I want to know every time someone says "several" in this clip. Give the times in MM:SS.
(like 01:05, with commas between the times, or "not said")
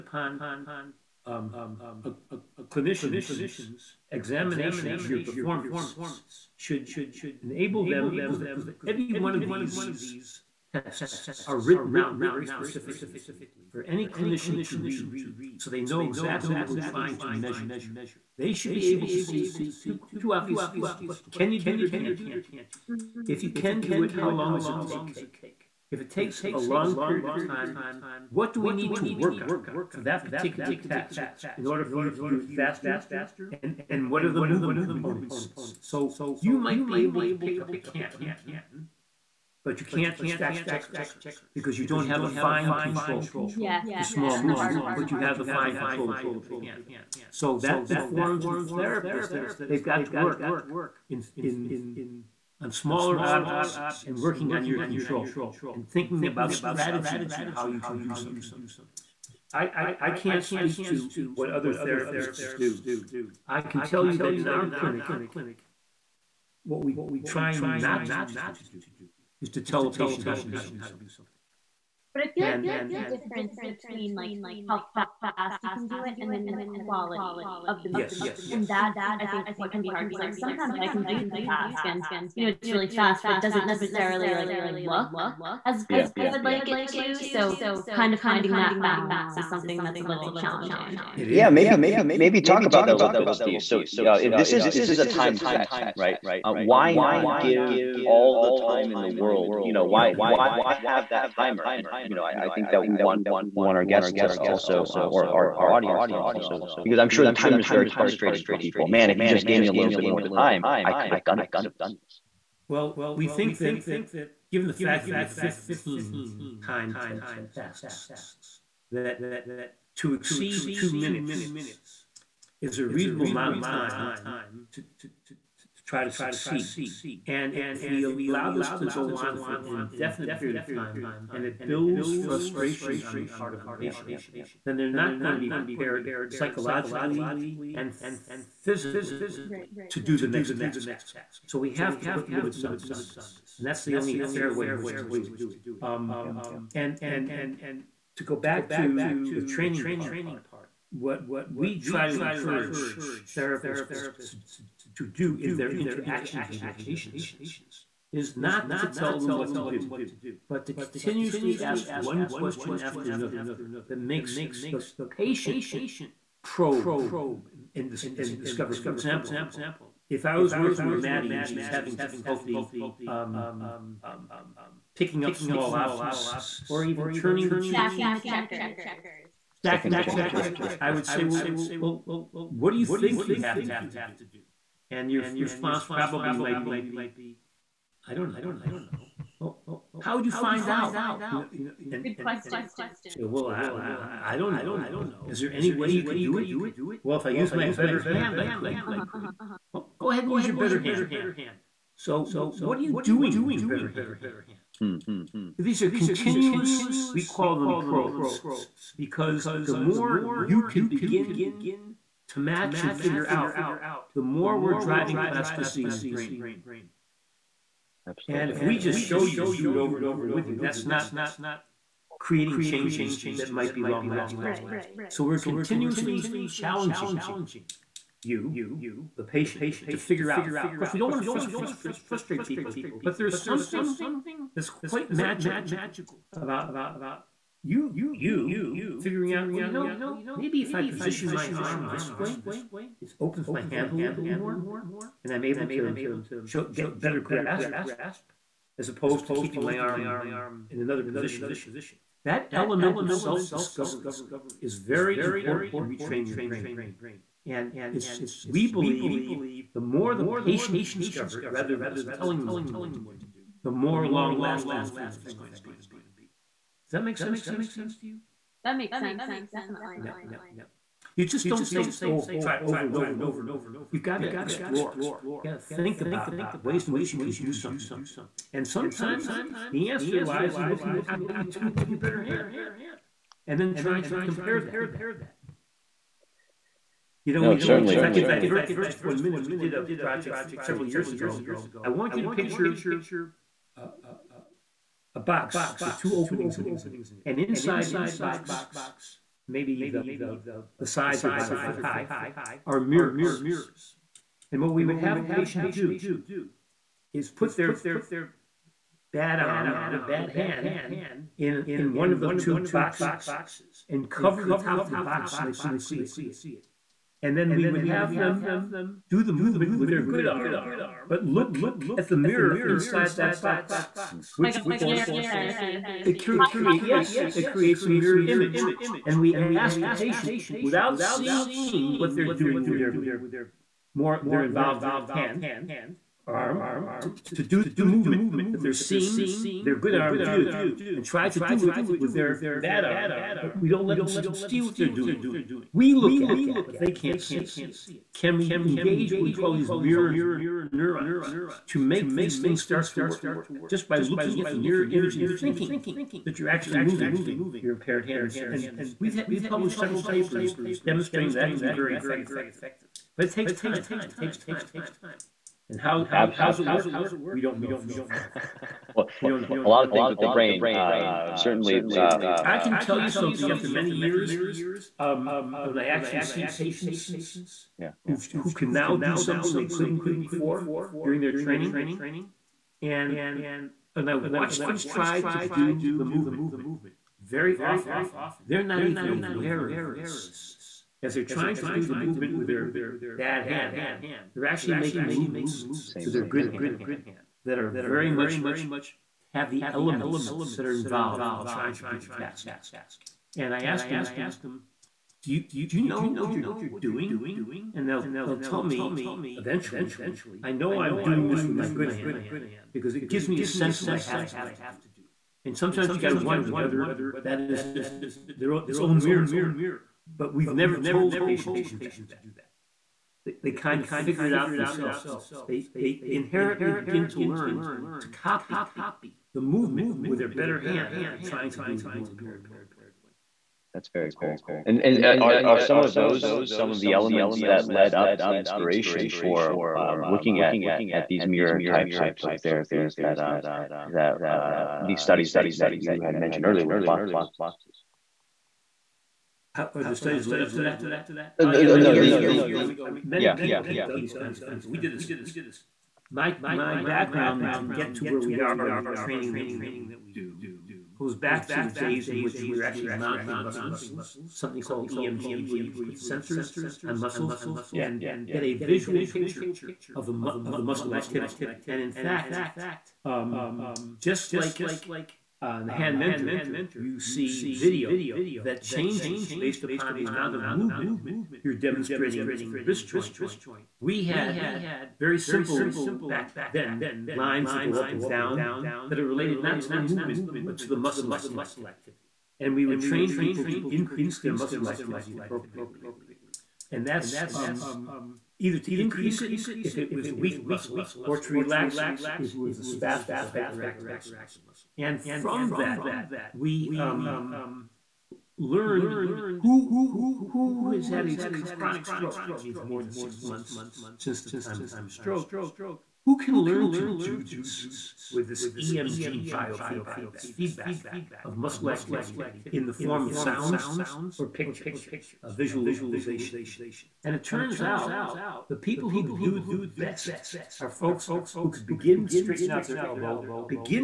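04:50, 05:59.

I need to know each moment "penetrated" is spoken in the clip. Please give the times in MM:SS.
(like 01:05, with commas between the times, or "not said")
not said.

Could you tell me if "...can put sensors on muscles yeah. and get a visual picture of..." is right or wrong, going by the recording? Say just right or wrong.
right.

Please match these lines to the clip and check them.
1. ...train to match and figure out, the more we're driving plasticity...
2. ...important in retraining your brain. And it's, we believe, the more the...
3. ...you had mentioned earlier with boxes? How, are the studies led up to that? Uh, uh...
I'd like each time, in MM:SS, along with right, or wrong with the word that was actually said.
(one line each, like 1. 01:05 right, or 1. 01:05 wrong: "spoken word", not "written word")
1. 03:30 wrong: "begin", not "train"
2. 04:15 right
3. 07:25 right.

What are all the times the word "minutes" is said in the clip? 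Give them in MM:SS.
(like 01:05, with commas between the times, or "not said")
02:00, 04:49.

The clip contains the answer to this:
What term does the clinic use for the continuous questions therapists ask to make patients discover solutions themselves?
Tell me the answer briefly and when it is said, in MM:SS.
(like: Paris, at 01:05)
probes, at 03:27.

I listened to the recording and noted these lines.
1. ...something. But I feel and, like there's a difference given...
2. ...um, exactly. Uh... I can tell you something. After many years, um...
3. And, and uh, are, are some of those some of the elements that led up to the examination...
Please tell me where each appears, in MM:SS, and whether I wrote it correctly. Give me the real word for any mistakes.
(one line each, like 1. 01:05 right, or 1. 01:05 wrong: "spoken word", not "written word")
1. 01:10 wrong: "between", not "given"
2. 06:10 wrong: "certainly", not "exactly"
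3. 07:14 wrong: "inspiration", not "examination".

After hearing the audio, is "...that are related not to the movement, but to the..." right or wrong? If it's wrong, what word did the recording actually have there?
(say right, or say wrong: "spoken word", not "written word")
right.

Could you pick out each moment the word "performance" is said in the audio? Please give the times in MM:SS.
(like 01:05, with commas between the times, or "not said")
00:05.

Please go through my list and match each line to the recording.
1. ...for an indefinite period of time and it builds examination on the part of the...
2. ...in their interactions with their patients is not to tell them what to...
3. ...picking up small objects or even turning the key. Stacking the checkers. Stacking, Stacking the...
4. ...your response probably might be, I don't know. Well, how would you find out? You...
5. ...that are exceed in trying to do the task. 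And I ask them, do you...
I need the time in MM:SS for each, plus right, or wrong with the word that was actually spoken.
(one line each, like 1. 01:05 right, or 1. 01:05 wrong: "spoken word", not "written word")
1. 02:09 wrong: "frustration", not "examination"
2. 02:35 right
3. 02:54 right
4. 03:05 right
5. 06:40 wrong: "involved", not "exceed".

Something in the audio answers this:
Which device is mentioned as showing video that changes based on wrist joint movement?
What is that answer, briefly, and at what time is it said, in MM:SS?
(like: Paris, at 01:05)
the hand mentor, at 07:55.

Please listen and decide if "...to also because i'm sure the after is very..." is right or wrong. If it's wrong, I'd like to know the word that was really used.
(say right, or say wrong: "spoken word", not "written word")
wrong: "timer", not "after".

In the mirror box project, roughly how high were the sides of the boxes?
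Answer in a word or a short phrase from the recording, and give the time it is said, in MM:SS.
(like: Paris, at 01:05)
about a foot, at 05:01.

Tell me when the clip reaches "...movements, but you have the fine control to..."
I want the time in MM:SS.
00:44.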